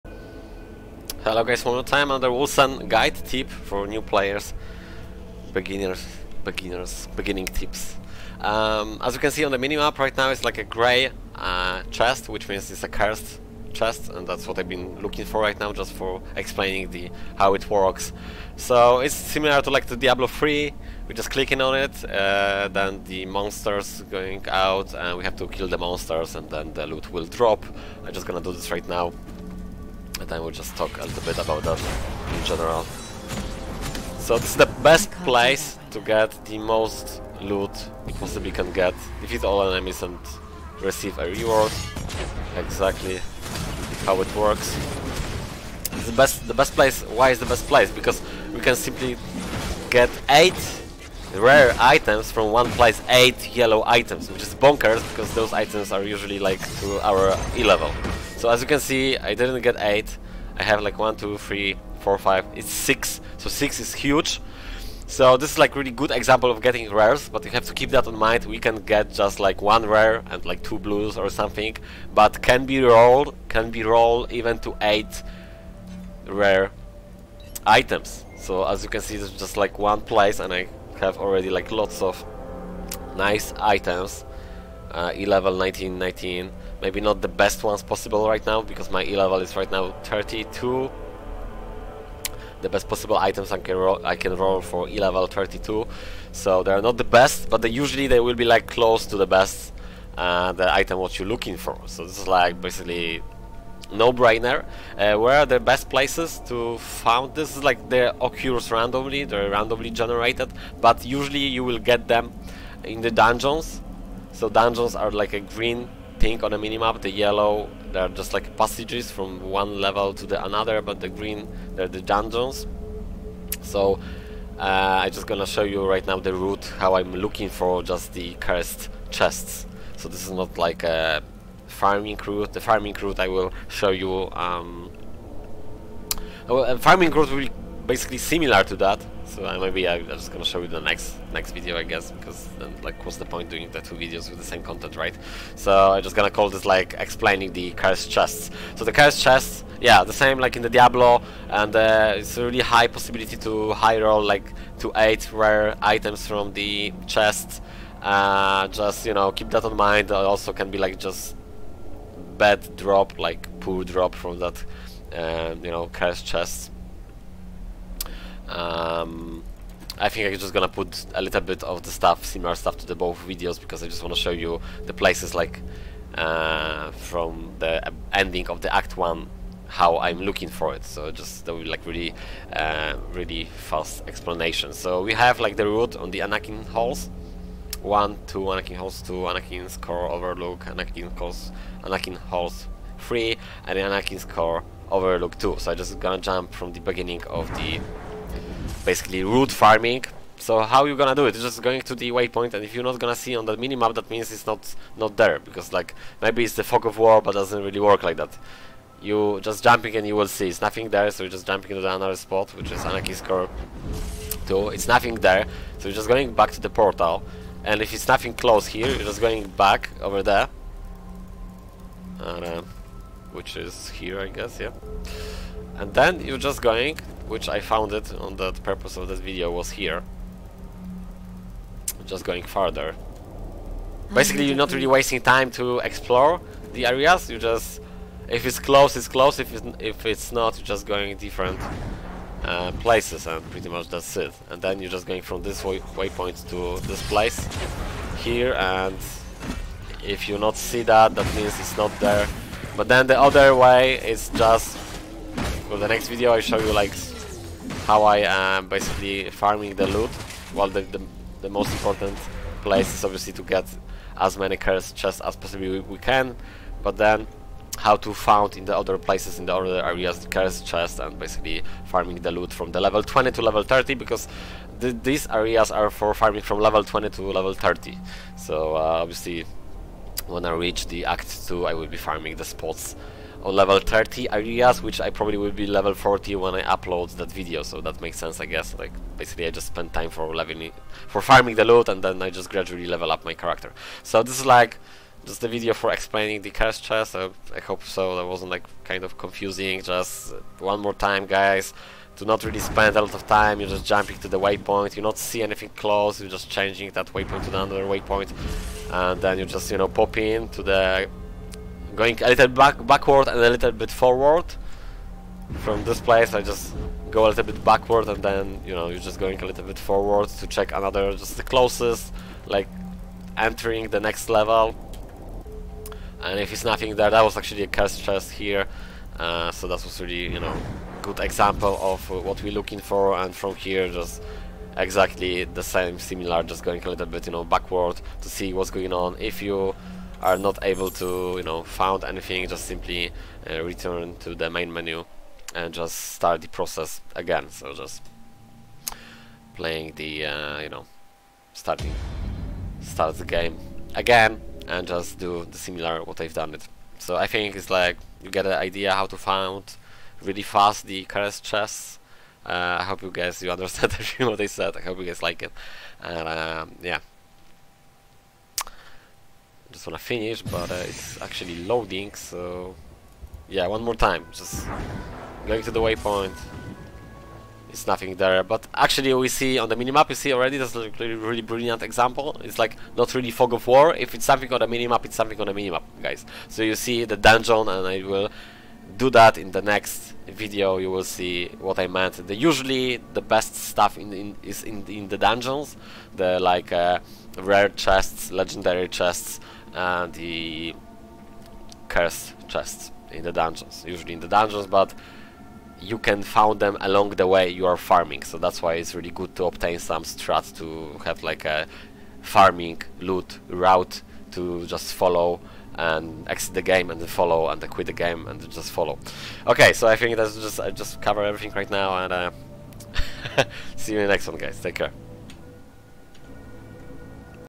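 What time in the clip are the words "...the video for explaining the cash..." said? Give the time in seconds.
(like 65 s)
295 s.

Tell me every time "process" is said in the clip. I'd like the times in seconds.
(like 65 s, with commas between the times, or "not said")
346 s.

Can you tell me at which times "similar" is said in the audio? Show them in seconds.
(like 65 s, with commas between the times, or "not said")
19 s, 138 s, 172 s, 335 s, 355 s.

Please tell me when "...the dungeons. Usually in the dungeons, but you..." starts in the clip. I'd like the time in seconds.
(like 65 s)
403 s.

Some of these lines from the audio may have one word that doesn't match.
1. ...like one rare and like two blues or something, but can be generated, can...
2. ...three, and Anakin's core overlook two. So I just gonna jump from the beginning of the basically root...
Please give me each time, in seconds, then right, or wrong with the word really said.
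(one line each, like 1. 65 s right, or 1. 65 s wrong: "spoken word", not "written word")
1. 69 s wrong: "rolled", not "generated"
2. 192 s right.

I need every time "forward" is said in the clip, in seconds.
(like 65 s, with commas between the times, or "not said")
313 s, 319 s.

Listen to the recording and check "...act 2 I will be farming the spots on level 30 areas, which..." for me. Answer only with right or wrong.
right.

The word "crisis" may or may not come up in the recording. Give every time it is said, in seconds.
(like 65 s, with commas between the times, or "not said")
not said.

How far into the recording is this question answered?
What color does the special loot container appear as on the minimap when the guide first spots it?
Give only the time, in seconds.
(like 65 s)
10 s.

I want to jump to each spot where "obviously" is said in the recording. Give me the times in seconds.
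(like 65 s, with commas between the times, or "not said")
263 s, 279 s.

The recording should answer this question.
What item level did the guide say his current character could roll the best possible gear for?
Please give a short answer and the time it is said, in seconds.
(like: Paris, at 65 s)
32, at 94 s.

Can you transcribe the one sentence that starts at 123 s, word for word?
So uh, I'm just gonna show you right now the route, how I'm looking for just the cursed chests.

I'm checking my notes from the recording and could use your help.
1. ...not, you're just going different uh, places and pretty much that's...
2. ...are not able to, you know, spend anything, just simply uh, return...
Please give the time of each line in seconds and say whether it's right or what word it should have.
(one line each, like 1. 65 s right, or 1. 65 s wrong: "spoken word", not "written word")
1. 240 s right
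2. 340 s wrong: "found", not "spend".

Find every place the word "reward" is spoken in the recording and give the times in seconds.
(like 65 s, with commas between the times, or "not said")
41 s.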